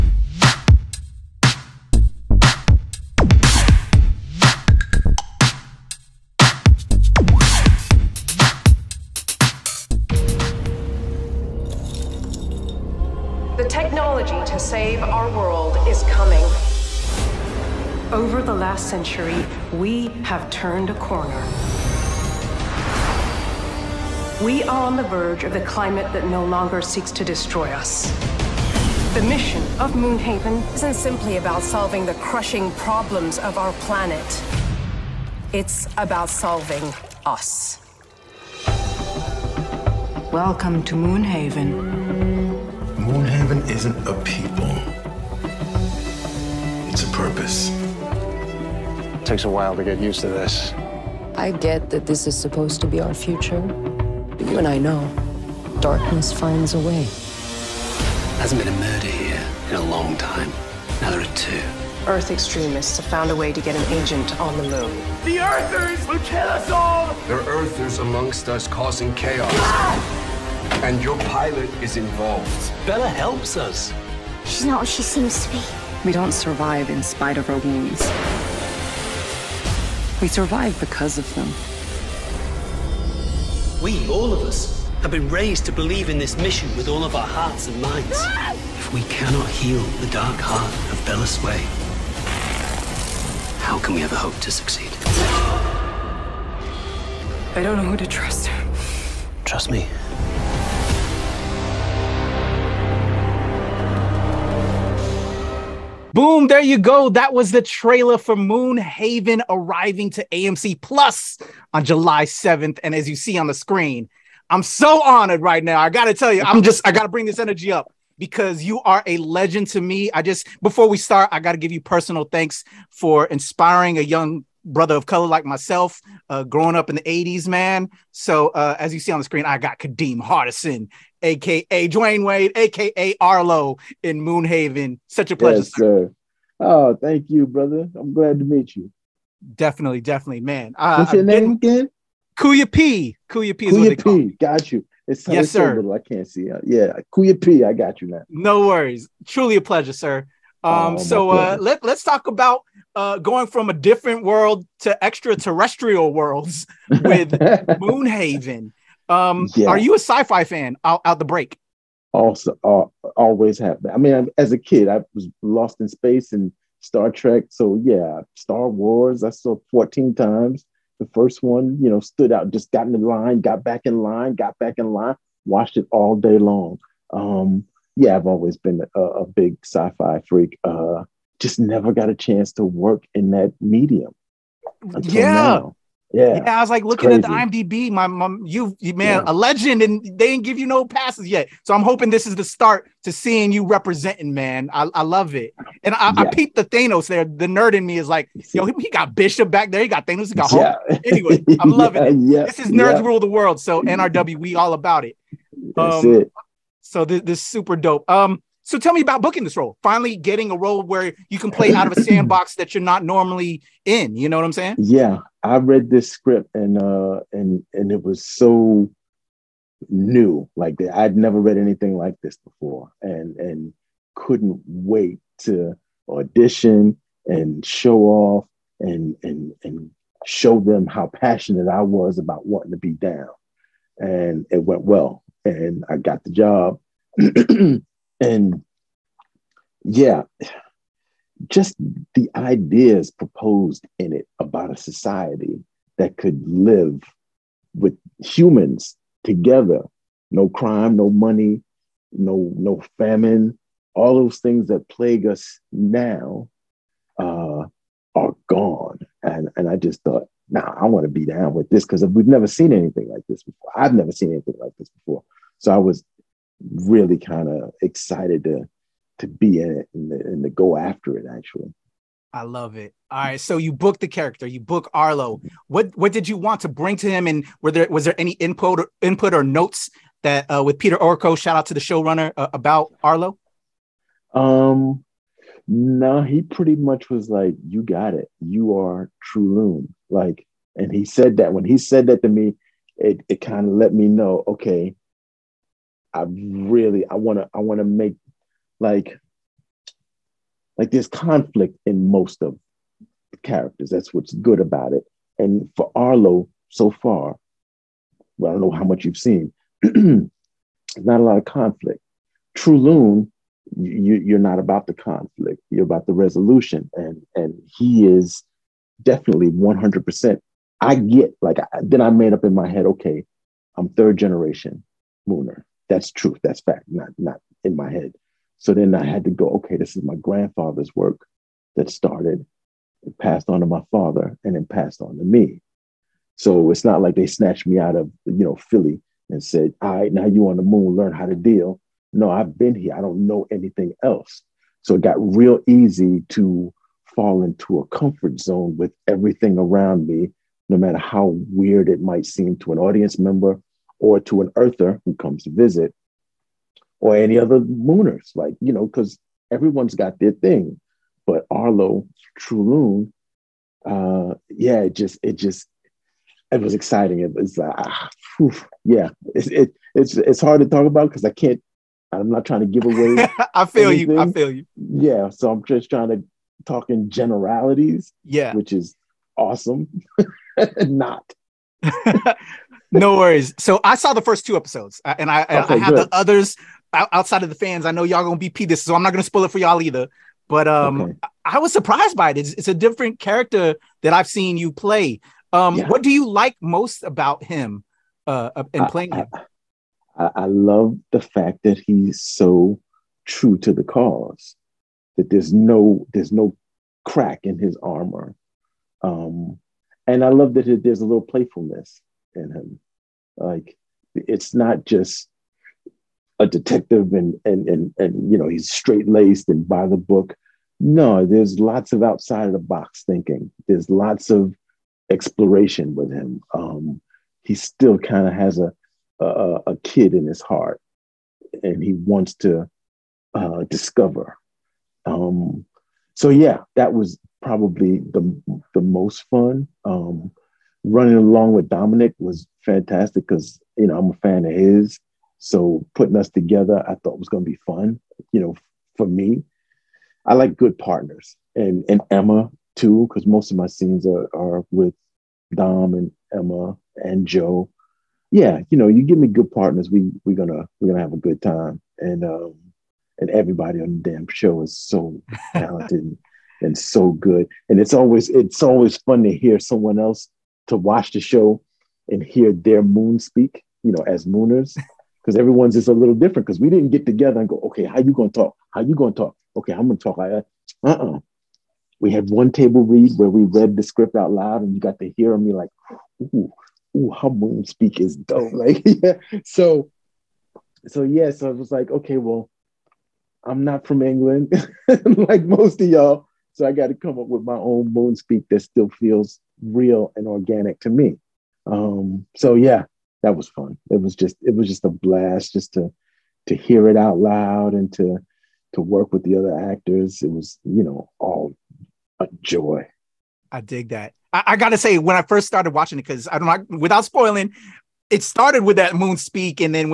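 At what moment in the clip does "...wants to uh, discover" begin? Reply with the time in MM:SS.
07:11.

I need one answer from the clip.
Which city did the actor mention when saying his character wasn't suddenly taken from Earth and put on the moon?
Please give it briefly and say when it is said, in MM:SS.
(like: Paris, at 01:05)
Philly, at 05:38.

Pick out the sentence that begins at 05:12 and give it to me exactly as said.
True Loon, you, are not about the conflict.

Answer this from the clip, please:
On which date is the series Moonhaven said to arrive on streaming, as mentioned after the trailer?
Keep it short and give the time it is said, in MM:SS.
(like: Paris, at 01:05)
July 7th, at 01:51.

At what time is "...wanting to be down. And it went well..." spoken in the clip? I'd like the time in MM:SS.
03:52.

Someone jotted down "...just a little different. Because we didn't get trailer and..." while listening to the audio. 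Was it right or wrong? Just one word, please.
wrong.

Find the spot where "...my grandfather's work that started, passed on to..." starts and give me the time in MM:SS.
05:30.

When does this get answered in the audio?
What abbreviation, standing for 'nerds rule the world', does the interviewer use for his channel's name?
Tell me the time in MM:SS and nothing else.
03:23.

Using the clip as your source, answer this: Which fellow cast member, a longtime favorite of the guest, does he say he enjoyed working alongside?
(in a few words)
Dominic.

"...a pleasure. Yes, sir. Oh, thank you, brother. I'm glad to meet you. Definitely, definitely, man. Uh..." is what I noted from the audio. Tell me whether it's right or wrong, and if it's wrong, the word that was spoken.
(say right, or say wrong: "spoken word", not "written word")
right.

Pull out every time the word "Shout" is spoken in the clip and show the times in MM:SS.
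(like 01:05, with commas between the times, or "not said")
04:41.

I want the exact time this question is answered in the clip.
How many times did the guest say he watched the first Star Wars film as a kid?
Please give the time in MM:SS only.
02:49.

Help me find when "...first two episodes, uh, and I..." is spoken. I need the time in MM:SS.
06:24.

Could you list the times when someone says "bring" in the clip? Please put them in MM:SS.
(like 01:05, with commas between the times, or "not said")
01:57, 04:36.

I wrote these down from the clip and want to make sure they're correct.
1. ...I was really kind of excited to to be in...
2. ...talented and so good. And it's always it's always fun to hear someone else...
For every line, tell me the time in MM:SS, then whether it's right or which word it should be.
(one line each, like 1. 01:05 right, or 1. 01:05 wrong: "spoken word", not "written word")
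1. 04:25 right
2. 07:45 right.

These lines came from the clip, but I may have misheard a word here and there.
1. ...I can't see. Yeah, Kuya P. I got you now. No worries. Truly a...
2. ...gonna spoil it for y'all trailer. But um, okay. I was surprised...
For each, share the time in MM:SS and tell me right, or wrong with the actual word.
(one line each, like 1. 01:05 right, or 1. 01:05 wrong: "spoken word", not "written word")
1. 02:25 right
2. 06:29 wrong: "either", not "trailer".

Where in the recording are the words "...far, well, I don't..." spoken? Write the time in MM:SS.
05:06.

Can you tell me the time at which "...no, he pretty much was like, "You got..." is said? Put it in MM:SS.
04:45.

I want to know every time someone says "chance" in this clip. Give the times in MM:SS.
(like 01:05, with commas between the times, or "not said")
03:02.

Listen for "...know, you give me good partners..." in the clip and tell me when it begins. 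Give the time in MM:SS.
07:38.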